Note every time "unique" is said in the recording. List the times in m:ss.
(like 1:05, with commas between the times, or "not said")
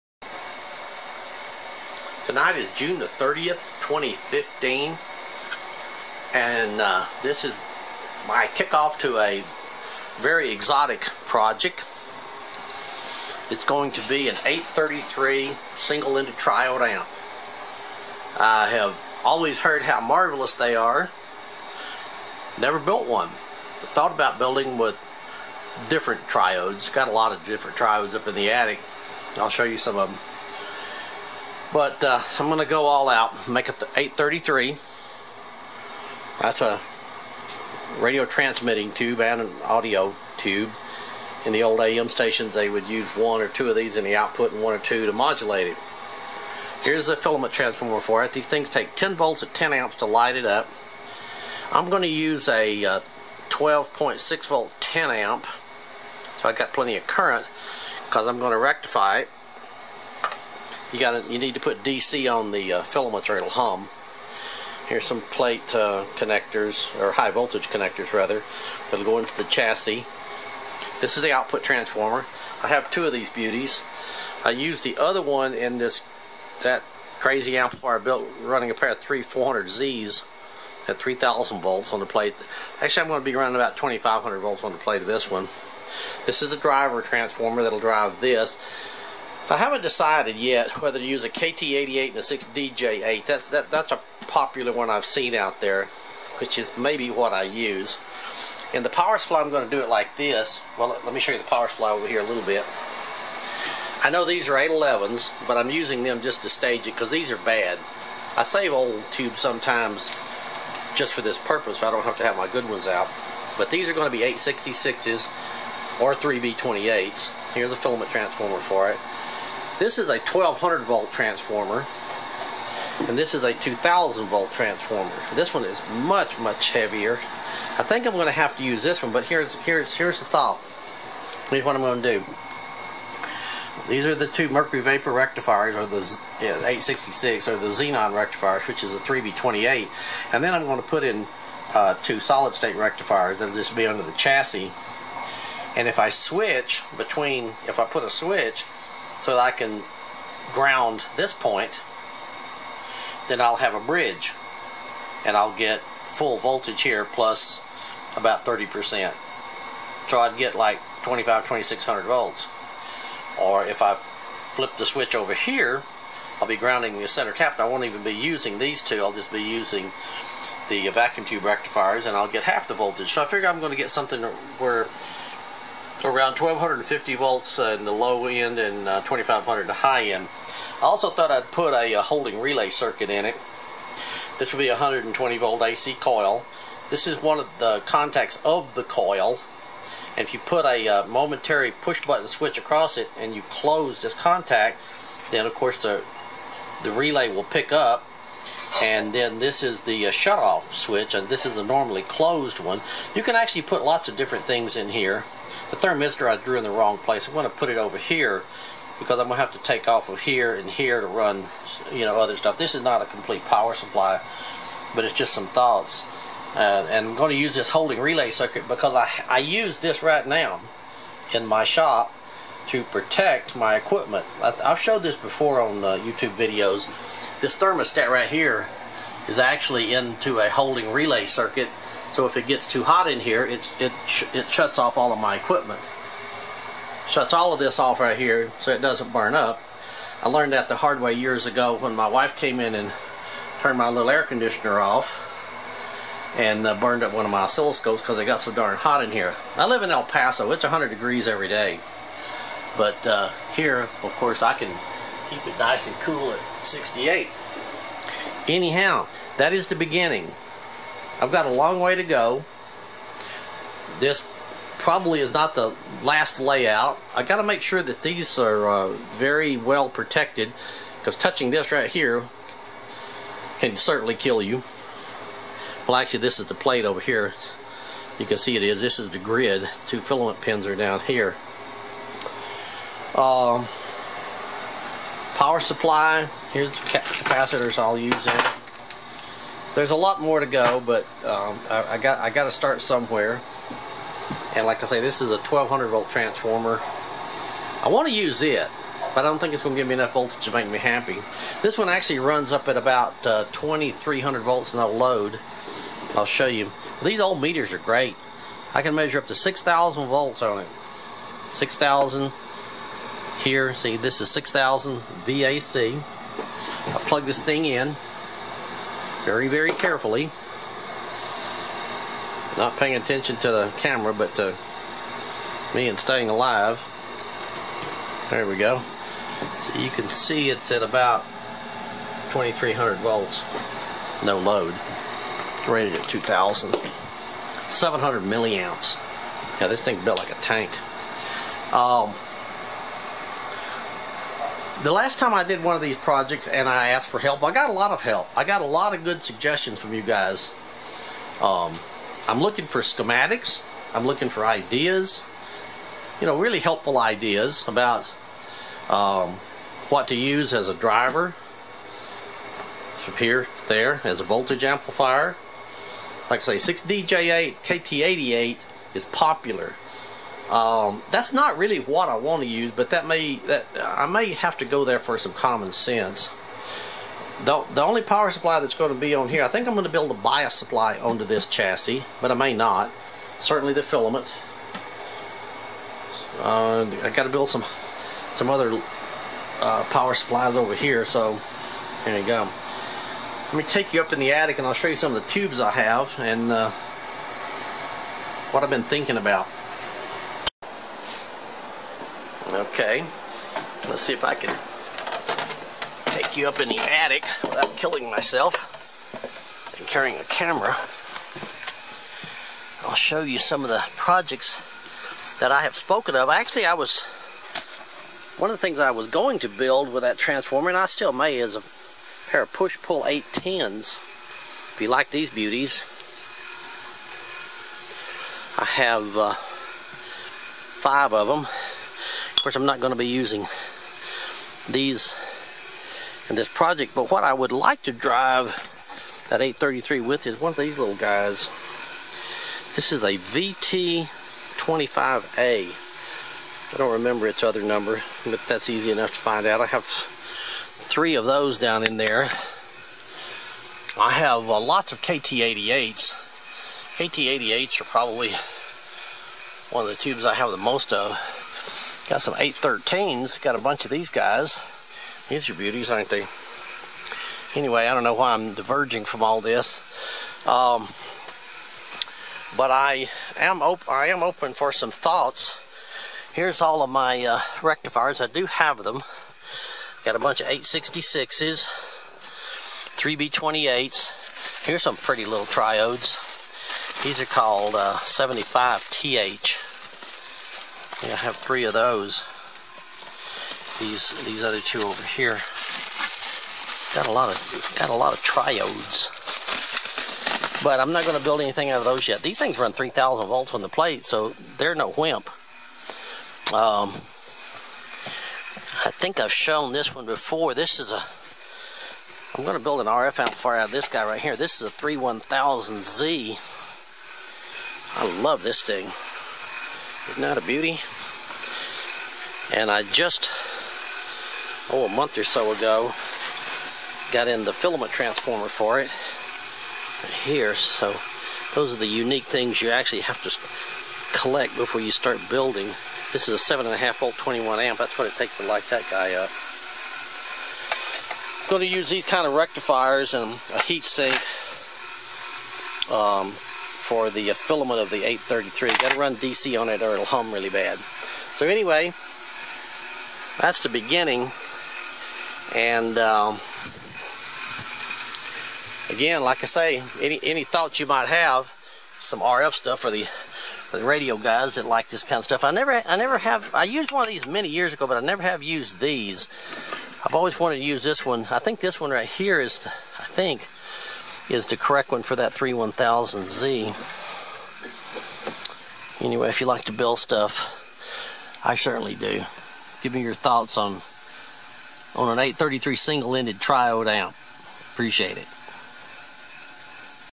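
8:51.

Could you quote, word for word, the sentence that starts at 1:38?
And the power supply, I'm going to do it like this.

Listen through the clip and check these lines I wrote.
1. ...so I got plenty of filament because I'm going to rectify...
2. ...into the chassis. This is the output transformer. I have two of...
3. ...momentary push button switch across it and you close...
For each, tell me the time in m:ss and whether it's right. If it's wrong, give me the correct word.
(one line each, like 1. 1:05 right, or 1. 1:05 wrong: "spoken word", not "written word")
1. 0:56 wrong: "current", not "filament"
2. 1:09 right
3. 3:11 right.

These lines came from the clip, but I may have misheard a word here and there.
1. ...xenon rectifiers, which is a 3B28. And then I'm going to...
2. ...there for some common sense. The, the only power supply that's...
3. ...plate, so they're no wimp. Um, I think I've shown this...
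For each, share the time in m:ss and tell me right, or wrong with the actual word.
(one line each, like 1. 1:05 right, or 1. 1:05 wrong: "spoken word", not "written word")
1. 2:17 right
2. 6:14 right
3. 8:23 right.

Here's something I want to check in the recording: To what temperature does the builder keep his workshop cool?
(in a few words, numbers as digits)
68.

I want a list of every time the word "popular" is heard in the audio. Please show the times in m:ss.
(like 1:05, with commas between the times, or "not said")
1:34, 6:09.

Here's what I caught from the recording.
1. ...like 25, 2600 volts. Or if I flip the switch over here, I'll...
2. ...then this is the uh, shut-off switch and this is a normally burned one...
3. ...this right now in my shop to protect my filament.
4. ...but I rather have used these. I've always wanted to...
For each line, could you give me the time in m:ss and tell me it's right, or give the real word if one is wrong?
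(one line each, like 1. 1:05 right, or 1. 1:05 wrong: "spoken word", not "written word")
1. 2:40 right
2. 3:19 wrong: "closed", not "burned"
3. 3:39 wrong: "equipment", not "filament"
4. 9:27 wrong: "never", not "rather".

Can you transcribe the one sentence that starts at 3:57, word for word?
Shuts all of this off right here so it doesn't burn up.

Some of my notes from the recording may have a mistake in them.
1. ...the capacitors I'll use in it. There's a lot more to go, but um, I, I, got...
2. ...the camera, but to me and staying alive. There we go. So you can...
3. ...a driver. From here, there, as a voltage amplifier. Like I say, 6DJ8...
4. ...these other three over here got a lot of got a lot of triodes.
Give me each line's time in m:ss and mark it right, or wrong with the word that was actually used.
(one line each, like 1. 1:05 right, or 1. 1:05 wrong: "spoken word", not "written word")
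1. 4:46 right
2. 5:23 right
3. 6:00 right
4. 8:14 wrong: "two", not "three".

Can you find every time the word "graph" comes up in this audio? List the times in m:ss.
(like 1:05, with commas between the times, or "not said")
not said.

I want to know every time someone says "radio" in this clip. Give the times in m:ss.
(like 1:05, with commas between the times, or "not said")
0:38, 9:23.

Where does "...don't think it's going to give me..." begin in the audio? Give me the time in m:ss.
4:59.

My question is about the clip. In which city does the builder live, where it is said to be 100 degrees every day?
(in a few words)
El Paso.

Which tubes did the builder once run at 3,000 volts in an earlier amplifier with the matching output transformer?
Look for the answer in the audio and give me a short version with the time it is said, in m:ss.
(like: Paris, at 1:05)
3-400Zs, at 1:18.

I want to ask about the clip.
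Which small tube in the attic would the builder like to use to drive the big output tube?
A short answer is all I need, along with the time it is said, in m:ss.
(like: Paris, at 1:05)
VT25A, at 7:23.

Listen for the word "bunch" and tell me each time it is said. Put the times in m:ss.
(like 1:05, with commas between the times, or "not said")
7:43, 8:00.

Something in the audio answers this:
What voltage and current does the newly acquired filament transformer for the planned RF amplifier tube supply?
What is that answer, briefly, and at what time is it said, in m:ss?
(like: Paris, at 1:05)
7.5 volt 21 amp, at 8:56.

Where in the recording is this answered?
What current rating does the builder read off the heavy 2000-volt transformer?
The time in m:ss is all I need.
5:36.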